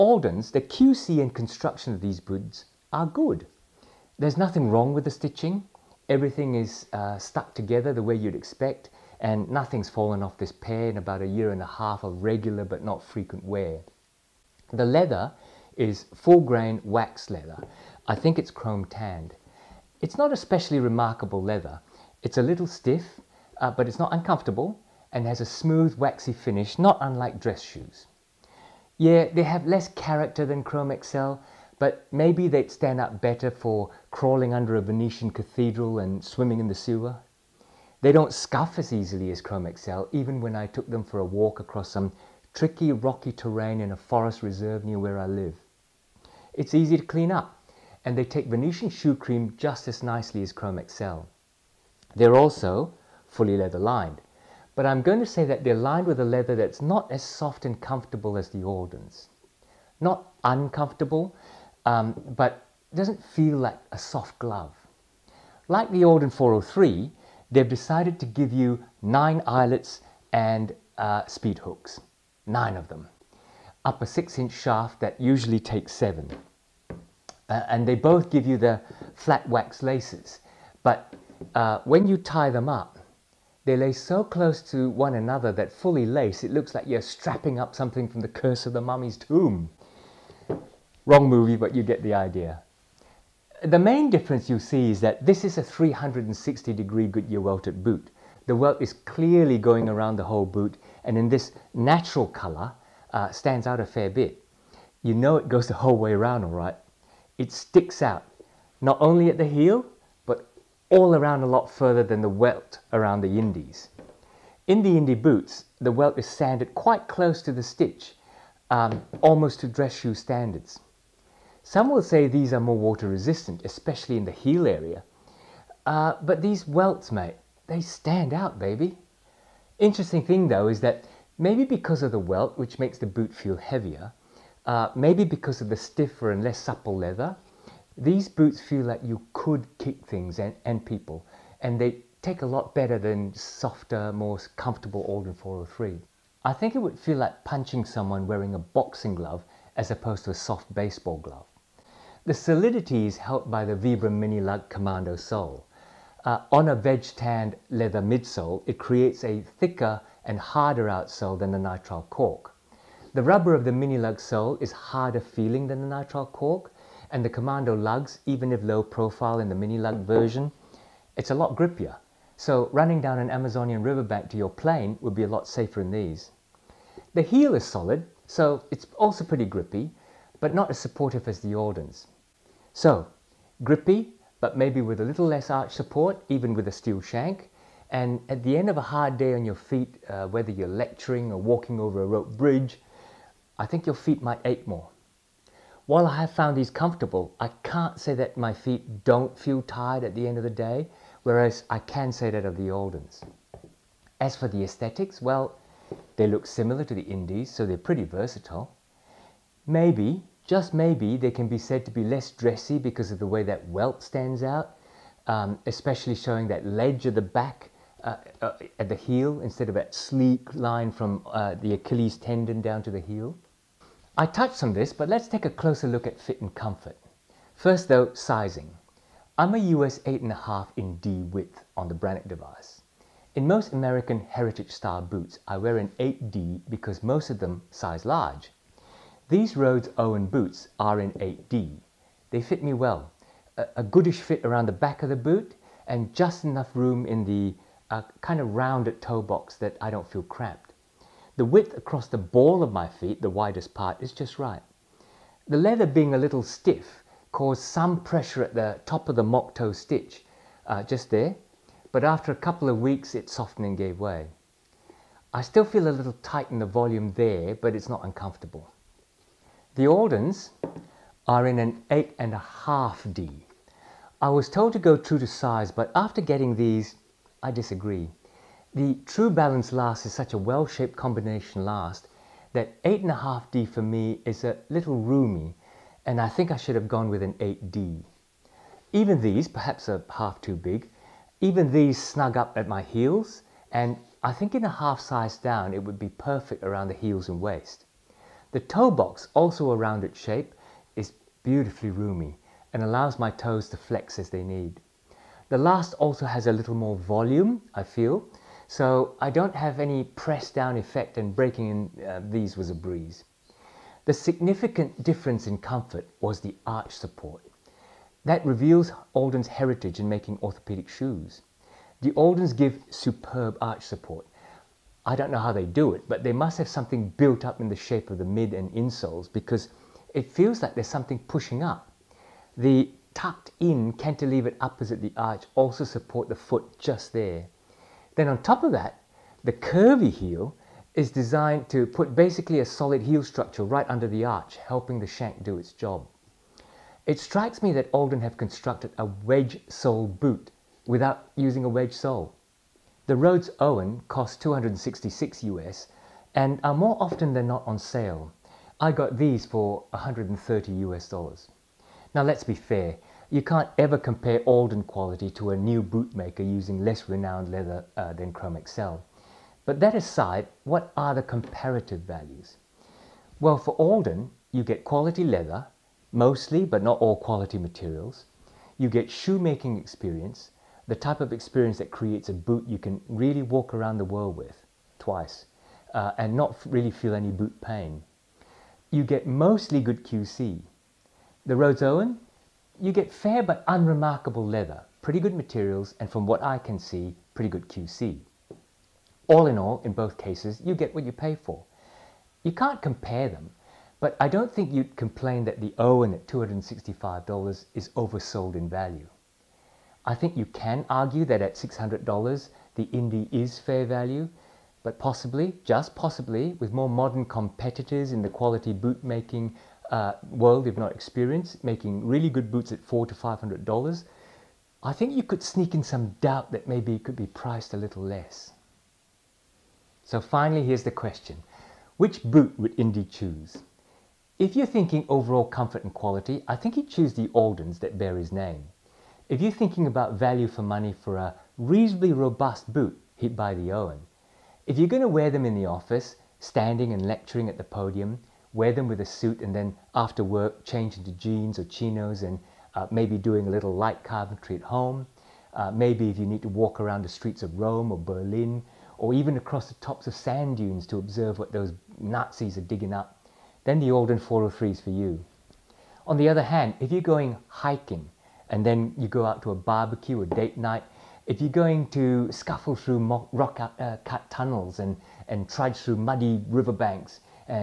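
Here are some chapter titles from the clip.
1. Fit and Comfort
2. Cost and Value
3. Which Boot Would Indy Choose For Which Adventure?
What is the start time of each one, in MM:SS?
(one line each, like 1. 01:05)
1. 03:43
2. 05:52
3. 07:08.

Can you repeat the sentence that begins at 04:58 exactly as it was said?
The toe box, also a rounded shape, is beautifully roomy and allows my toes to flex as they need.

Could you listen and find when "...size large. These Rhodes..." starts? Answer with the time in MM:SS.
03:57.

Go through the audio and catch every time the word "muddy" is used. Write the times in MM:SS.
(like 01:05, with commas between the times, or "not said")
07:55.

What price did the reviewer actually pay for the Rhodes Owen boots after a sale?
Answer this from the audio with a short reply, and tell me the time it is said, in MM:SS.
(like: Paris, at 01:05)
$130, at 05:59.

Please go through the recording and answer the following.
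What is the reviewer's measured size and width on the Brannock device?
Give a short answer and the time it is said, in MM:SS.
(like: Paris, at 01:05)
US 8.5 D, at 03:49.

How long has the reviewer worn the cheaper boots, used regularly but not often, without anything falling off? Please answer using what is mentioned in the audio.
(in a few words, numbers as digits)
a year and a half.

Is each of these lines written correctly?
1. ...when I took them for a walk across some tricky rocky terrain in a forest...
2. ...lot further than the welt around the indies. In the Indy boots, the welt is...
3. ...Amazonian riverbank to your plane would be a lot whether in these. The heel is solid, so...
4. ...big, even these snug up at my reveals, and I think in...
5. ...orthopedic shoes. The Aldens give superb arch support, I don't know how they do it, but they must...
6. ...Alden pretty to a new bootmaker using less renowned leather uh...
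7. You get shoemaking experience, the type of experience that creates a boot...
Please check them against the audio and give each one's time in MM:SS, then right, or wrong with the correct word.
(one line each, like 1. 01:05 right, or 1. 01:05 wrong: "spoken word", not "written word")
1. 00:40 right
2. 01:51 right
3. 02:53 wrong: "safer", not "whether"
4. 04:50 wrong: "heels", not "reveals"
5. 05:20 right
6. 06:04 wrong: "quality", not "pretty"
7. 06:18 right.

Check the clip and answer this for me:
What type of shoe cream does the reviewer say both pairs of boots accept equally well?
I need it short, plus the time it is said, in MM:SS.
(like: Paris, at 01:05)
Venetian shoe cream, at 00:48.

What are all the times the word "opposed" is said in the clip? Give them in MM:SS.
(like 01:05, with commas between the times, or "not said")
02:29.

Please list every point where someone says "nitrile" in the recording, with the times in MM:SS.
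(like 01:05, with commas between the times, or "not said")
02:41, 02:45.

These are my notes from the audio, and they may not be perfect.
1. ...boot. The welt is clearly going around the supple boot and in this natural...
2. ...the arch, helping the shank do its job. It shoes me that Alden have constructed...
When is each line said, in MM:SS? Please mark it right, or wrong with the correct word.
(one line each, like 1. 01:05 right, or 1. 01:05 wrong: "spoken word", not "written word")
1. 01:37 wrong: "whole", not "supple"
2. 05:44 wrong: "strikes", not "shoes".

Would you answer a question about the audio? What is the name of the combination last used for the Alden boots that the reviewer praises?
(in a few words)
Trubalance.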